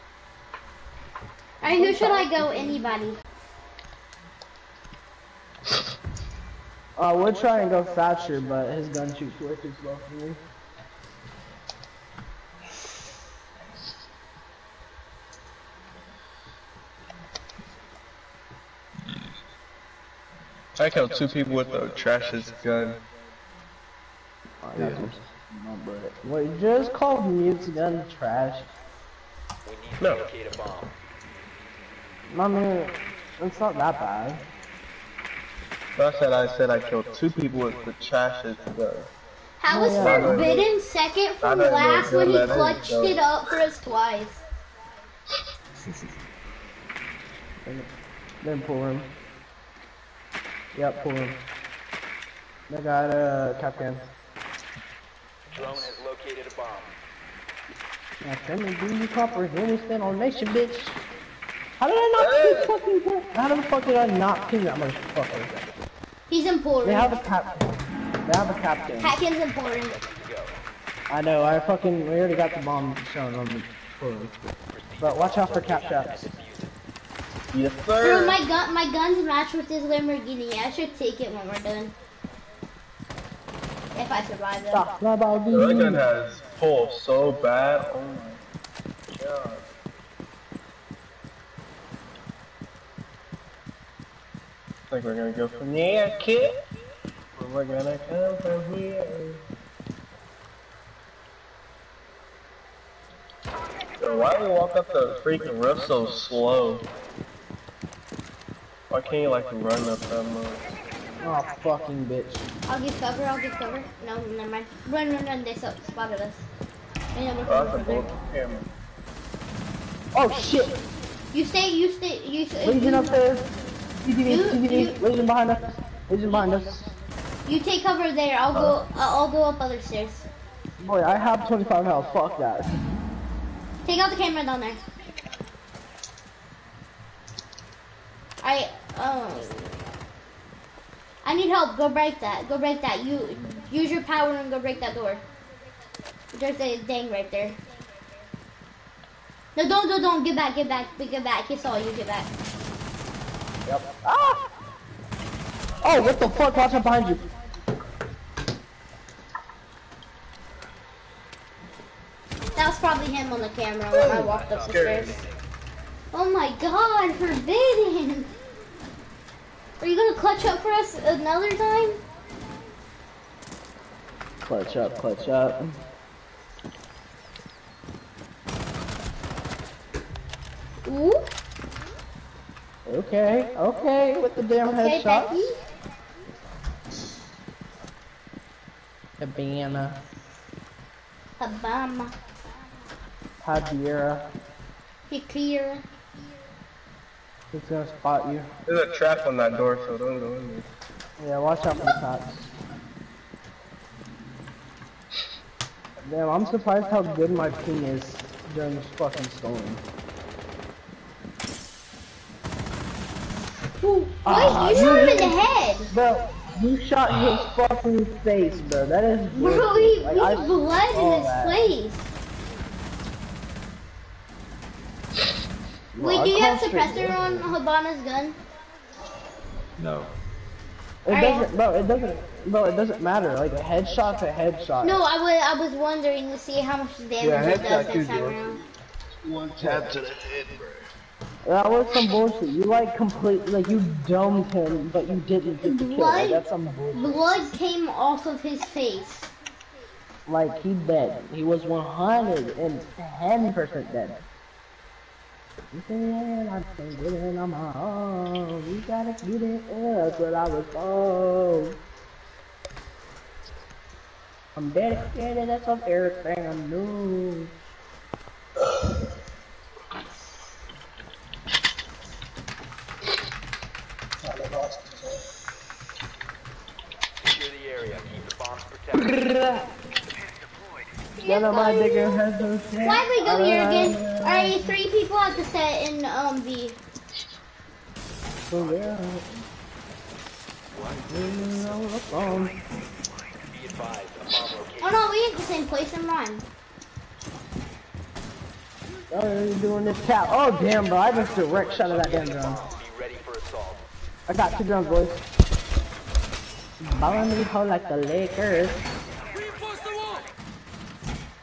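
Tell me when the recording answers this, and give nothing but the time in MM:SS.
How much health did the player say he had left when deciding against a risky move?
02:11.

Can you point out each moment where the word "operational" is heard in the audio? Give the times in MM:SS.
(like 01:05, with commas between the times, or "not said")
not said.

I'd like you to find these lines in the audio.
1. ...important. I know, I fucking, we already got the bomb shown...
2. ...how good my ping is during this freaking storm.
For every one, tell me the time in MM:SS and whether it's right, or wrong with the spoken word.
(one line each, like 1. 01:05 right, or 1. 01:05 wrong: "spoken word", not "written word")
1. 01:09 right
2. 03:26 wrong: "fucking", not "freaking".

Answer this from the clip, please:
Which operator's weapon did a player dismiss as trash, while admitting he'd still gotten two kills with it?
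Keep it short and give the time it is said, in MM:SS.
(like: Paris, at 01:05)
Mute, at 00:27.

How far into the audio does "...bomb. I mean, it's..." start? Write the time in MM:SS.
00:30.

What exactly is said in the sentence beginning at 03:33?
Wait, ah, you shot him in the head!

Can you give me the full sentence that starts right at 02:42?
That was probably him on the camera when I walked up the stairs.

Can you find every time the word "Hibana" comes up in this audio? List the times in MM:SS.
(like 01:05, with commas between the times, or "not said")
03:09, 03:47.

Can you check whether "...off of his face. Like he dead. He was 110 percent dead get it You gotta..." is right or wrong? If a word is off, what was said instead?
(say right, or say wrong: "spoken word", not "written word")
right.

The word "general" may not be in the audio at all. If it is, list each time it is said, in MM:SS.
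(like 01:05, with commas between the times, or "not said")
not said.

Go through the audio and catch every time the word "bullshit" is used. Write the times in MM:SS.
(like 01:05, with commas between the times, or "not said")
04:02, 04:06.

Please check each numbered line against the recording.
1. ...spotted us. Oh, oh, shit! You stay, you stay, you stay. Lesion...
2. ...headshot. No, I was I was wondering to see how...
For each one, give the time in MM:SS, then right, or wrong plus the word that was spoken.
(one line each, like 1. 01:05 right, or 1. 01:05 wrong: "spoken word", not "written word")
1. 01:55 right
2. 03:54 right.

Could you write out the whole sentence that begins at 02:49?
Are you gonna clutch up for us another time?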